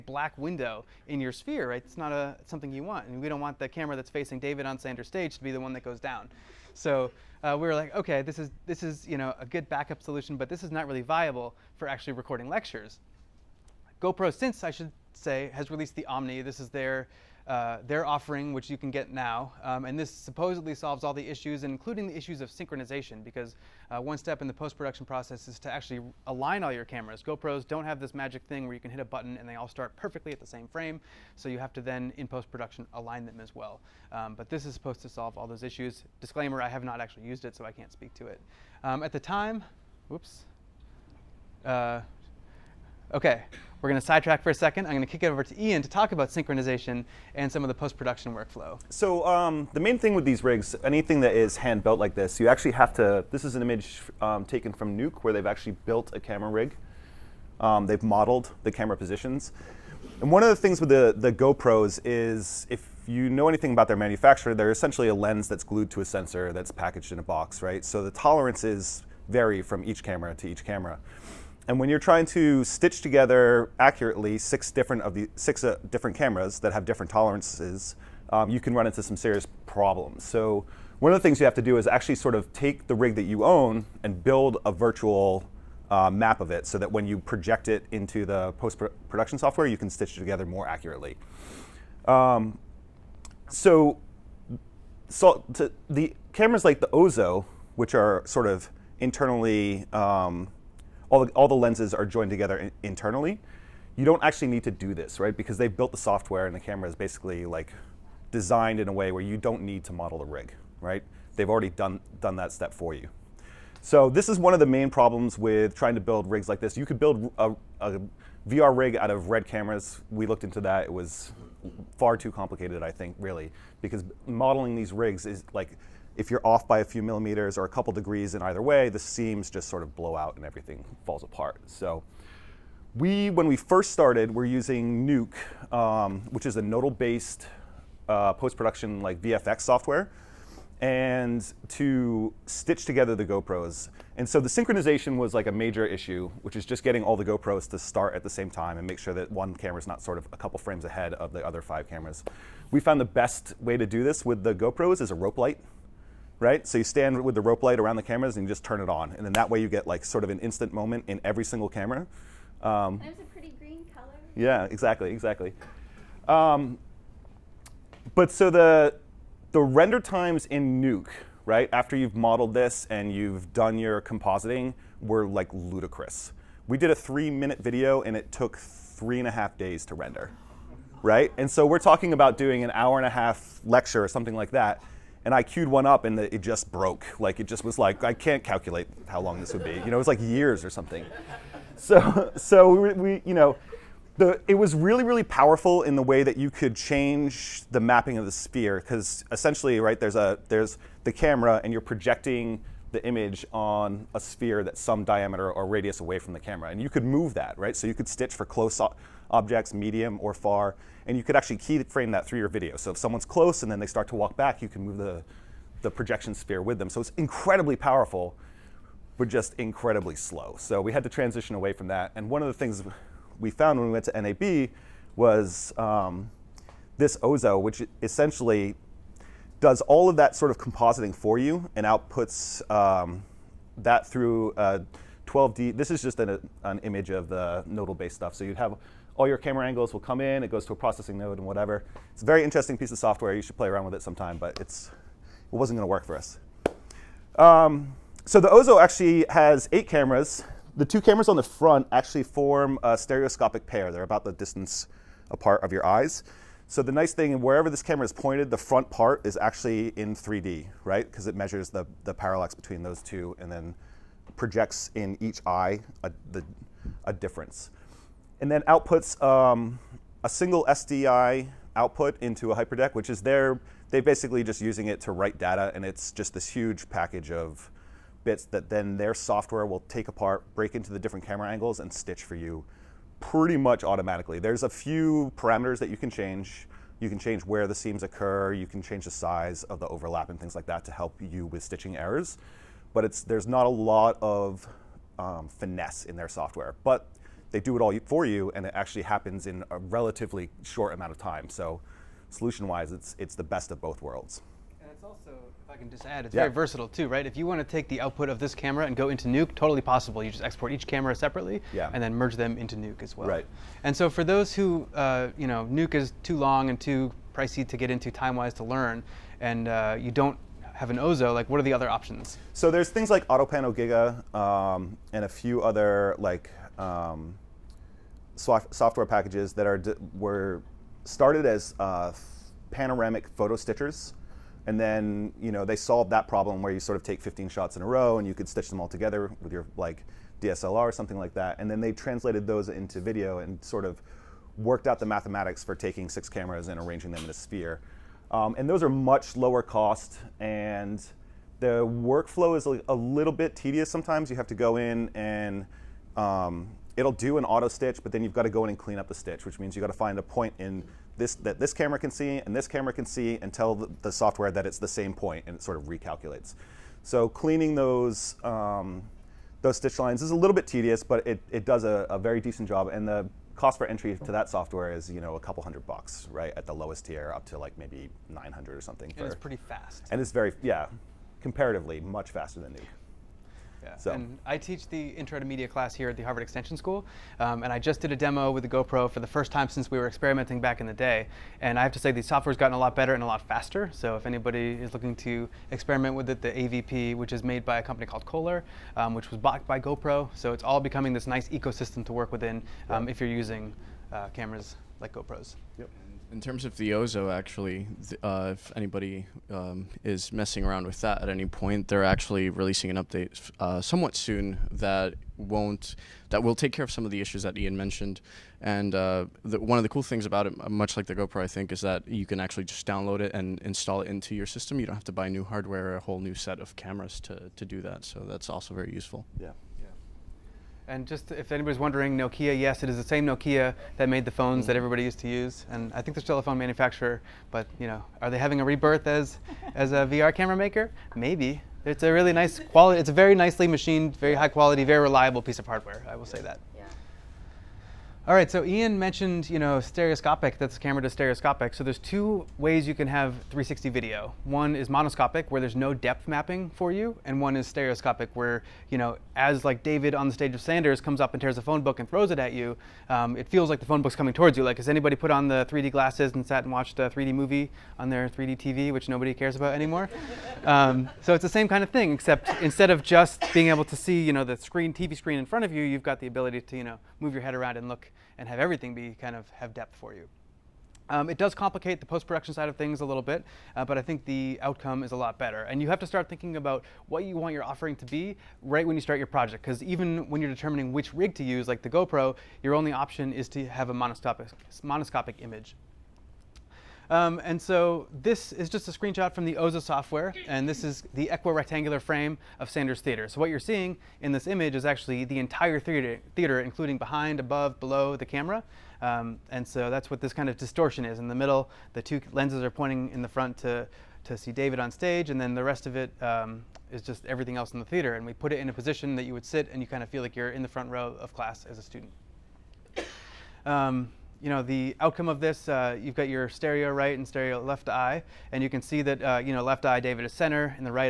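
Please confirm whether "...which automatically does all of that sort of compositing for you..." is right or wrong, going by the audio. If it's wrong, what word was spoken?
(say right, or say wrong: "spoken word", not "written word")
wrong: "essentially", not "automatically".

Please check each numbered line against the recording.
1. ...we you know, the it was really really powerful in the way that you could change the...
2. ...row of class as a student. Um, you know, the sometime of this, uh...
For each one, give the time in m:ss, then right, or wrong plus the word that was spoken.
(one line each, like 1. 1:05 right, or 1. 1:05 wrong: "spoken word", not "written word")
1. 3:12 right
2. 8:40 wrong: "outcome", not "sometime".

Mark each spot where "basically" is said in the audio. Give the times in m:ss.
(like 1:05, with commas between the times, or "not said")
1:46, 4:34.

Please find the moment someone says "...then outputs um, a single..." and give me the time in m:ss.
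4:28.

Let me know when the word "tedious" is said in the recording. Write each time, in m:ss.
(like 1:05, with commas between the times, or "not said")
5:53, 6:10.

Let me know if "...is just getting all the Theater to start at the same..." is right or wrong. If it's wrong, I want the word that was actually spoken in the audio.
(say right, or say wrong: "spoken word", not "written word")
wrong: "GoPros", not "Theater".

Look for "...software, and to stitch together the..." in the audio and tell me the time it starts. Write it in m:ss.
2:19.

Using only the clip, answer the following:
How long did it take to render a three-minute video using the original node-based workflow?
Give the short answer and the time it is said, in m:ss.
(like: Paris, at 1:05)
3.5 days, at 2:58.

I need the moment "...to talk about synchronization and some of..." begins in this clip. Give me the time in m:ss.
0:45.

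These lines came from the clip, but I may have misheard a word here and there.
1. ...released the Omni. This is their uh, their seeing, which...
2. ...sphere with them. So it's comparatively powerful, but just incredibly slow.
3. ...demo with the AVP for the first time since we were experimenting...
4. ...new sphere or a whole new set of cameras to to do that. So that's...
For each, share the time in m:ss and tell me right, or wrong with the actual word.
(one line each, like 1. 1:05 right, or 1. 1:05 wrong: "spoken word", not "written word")
1. 0:15 wrong: "offering", not "seeing"
2. 3:36 wrong: "incredibly", not "comparatively"
3. 6:28 wrong: "GoPro", not "AVP"
4. 7:05 wrong: "hardware", not "sphere".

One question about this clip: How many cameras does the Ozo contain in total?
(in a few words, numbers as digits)
8.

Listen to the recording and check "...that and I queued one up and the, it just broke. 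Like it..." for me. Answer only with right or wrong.
right.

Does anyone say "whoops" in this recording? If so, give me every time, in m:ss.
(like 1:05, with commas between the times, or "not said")
0:40.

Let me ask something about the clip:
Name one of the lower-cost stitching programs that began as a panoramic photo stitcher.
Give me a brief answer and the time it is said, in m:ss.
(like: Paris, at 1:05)
AutoPano Giga, at 5:23.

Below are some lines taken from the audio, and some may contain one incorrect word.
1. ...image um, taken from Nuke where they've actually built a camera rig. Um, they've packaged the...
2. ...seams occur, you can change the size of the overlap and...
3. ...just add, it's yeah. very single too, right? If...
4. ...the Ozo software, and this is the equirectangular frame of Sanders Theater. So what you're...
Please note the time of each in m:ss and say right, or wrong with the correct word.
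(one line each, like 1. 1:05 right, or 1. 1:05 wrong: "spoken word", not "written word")
1. 0:53 wrong: "modeled", not "packaged"
2. 4:47 right
3. 5:05 wrong: "versatile", not "single"
4. 8:19 right.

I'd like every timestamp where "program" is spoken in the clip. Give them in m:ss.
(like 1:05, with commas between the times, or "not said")
not said.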